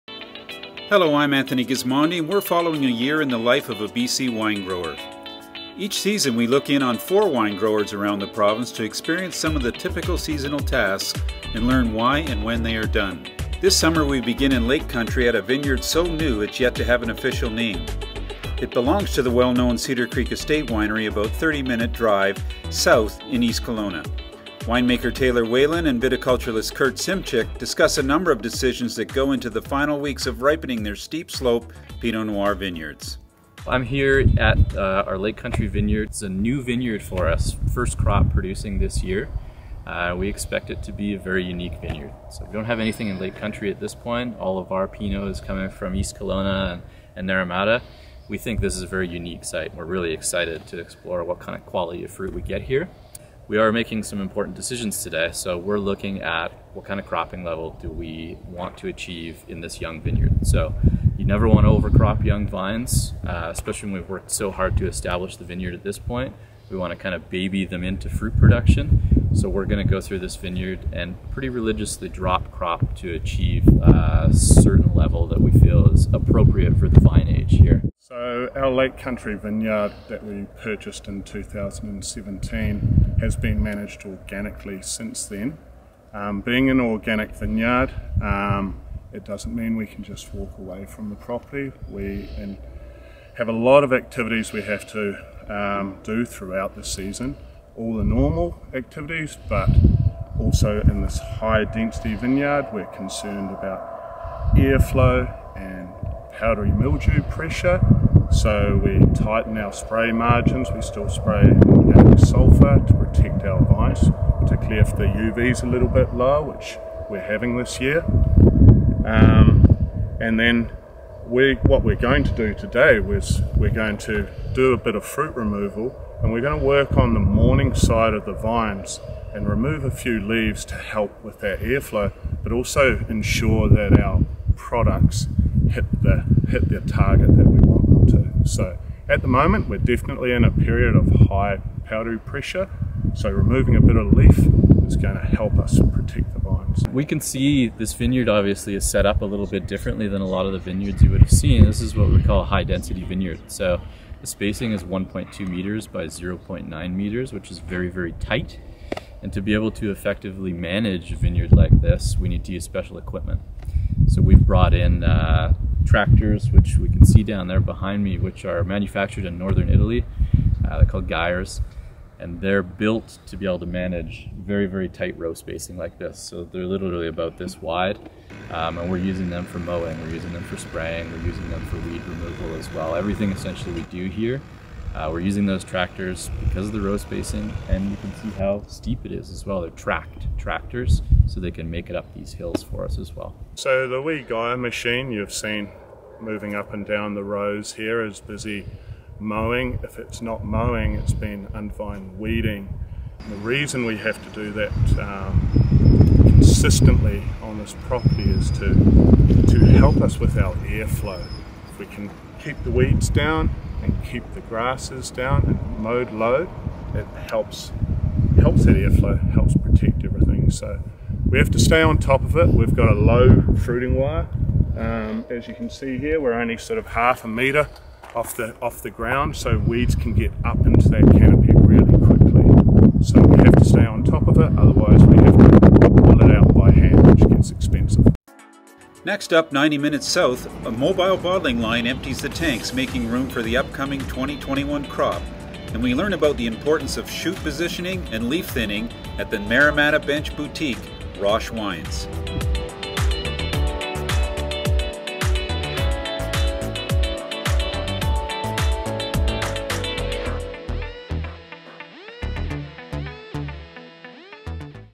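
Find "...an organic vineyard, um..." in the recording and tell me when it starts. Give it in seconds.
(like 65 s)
86 s.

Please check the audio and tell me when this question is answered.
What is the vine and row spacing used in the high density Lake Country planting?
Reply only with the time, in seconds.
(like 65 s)
154 s.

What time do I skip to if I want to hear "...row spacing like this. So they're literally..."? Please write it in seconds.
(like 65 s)
175 s.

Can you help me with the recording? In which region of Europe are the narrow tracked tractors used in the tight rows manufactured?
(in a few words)
Northern Italy.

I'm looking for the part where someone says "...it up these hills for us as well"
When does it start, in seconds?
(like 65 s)
191 s.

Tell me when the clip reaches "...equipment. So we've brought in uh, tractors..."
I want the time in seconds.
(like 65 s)
162 s.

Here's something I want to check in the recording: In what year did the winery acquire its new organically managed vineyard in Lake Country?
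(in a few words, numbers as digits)
2017.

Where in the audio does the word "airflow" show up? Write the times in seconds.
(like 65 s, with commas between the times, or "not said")
104 s, 131 s, 210 s, 218 s.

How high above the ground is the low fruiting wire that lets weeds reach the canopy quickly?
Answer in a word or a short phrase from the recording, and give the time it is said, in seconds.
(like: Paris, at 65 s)
Half a meter, at 226 s.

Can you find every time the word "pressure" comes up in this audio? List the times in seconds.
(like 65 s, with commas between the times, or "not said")
107 s, 142 s.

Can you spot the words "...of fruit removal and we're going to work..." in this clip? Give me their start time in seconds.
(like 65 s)
124 s.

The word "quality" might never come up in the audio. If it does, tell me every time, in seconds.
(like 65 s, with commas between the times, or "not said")
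51 s.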